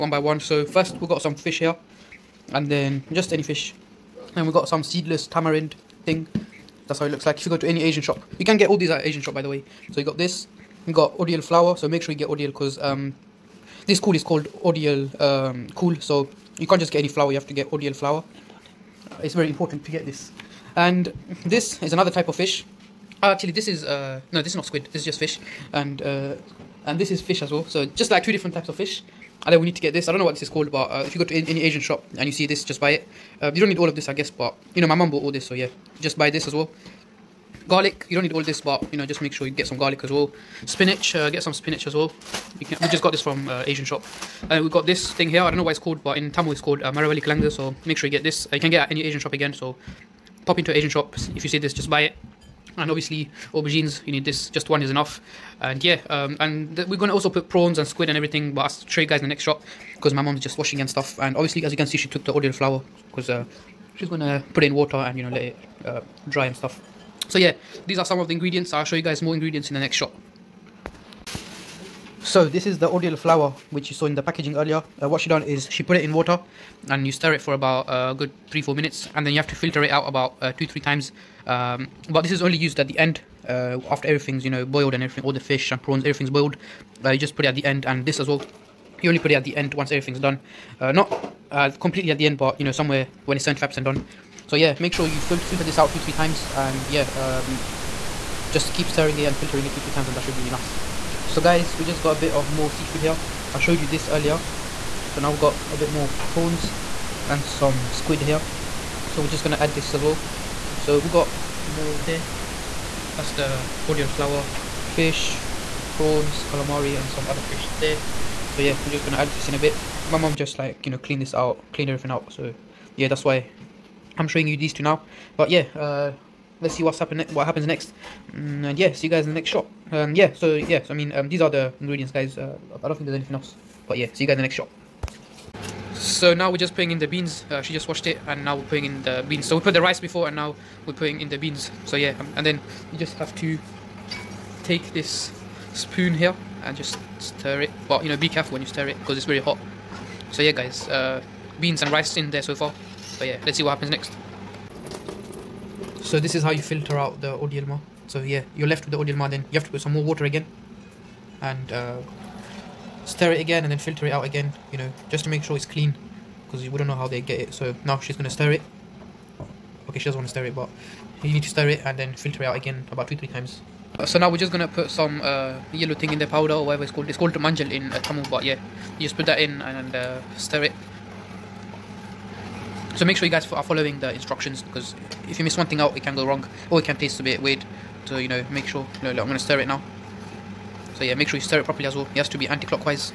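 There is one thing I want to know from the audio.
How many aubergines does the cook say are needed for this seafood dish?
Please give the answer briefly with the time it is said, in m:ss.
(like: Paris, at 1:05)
1, at 0:54.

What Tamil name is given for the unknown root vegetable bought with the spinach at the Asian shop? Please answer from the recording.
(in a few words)
Maravali Kalanga.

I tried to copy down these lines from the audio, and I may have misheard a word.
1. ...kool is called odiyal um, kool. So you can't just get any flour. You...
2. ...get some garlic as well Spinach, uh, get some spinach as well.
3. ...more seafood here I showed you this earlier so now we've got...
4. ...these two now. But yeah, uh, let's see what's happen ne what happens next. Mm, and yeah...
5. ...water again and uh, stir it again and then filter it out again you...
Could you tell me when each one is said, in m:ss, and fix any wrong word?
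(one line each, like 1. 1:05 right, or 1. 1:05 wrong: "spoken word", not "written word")
1. 0:13 right
2. 0:39 right
3. 1:42 right
4. 2:04 right
5. 2:40 right.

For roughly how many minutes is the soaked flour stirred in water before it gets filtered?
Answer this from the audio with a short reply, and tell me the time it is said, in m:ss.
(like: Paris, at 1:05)
3-4 minutes, at 1:18.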